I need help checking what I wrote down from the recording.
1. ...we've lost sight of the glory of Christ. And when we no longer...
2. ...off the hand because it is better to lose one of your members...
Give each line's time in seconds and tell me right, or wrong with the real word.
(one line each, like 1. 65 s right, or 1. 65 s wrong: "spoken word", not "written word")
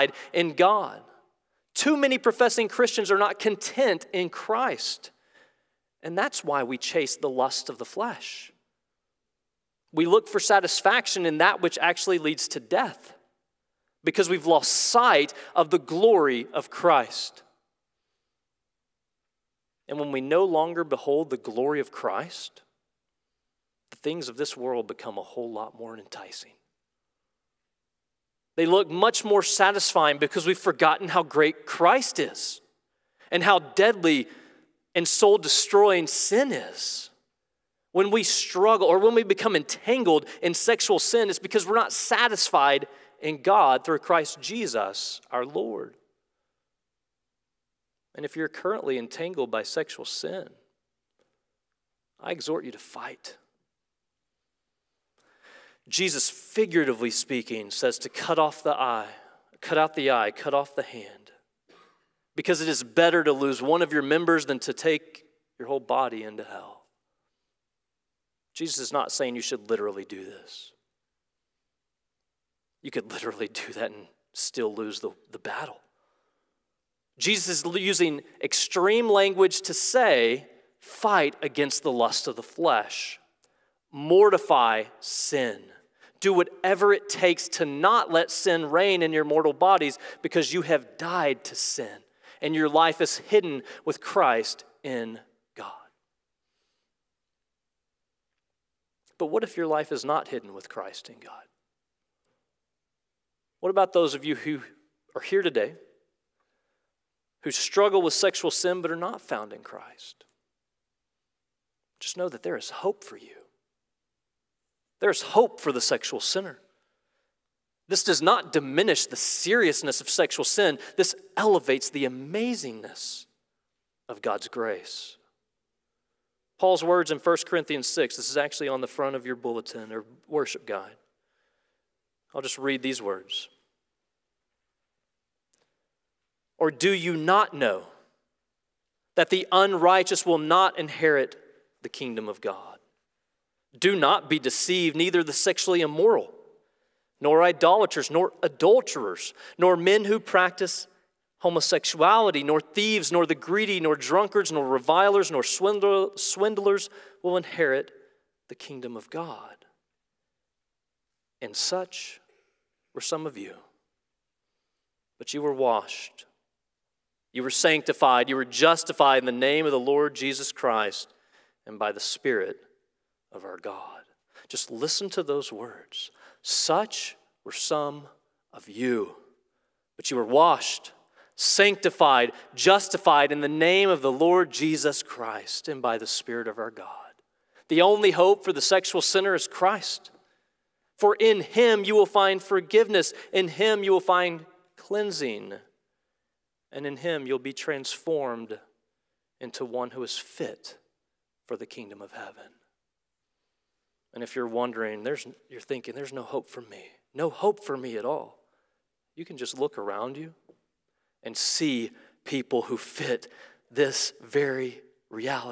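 1. 14 s right
2. 60 s right.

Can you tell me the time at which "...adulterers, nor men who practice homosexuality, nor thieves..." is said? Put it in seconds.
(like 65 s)
148 s.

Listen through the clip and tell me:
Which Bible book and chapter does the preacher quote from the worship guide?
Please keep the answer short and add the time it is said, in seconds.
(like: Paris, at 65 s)
1 Corinthians 6, at 127 s.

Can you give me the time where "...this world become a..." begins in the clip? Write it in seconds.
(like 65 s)
24 s.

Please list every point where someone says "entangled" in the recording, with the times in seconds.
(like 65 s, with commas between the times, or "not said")
39 s, 48 s.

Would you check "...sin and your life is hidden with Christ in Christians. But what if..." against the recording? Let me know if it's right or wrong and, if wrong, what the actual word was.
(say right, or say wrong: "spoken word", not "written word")
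wrong: "God", not "Christians".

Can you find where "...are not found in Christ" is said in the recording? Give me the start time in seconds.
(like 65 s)
108 s.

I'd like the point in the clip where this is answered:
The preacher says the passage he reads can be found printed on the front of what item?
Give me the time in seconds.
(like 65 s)
129 s.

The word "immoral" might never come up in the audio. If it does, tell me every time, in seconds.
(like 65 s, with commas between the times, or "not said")
145 s.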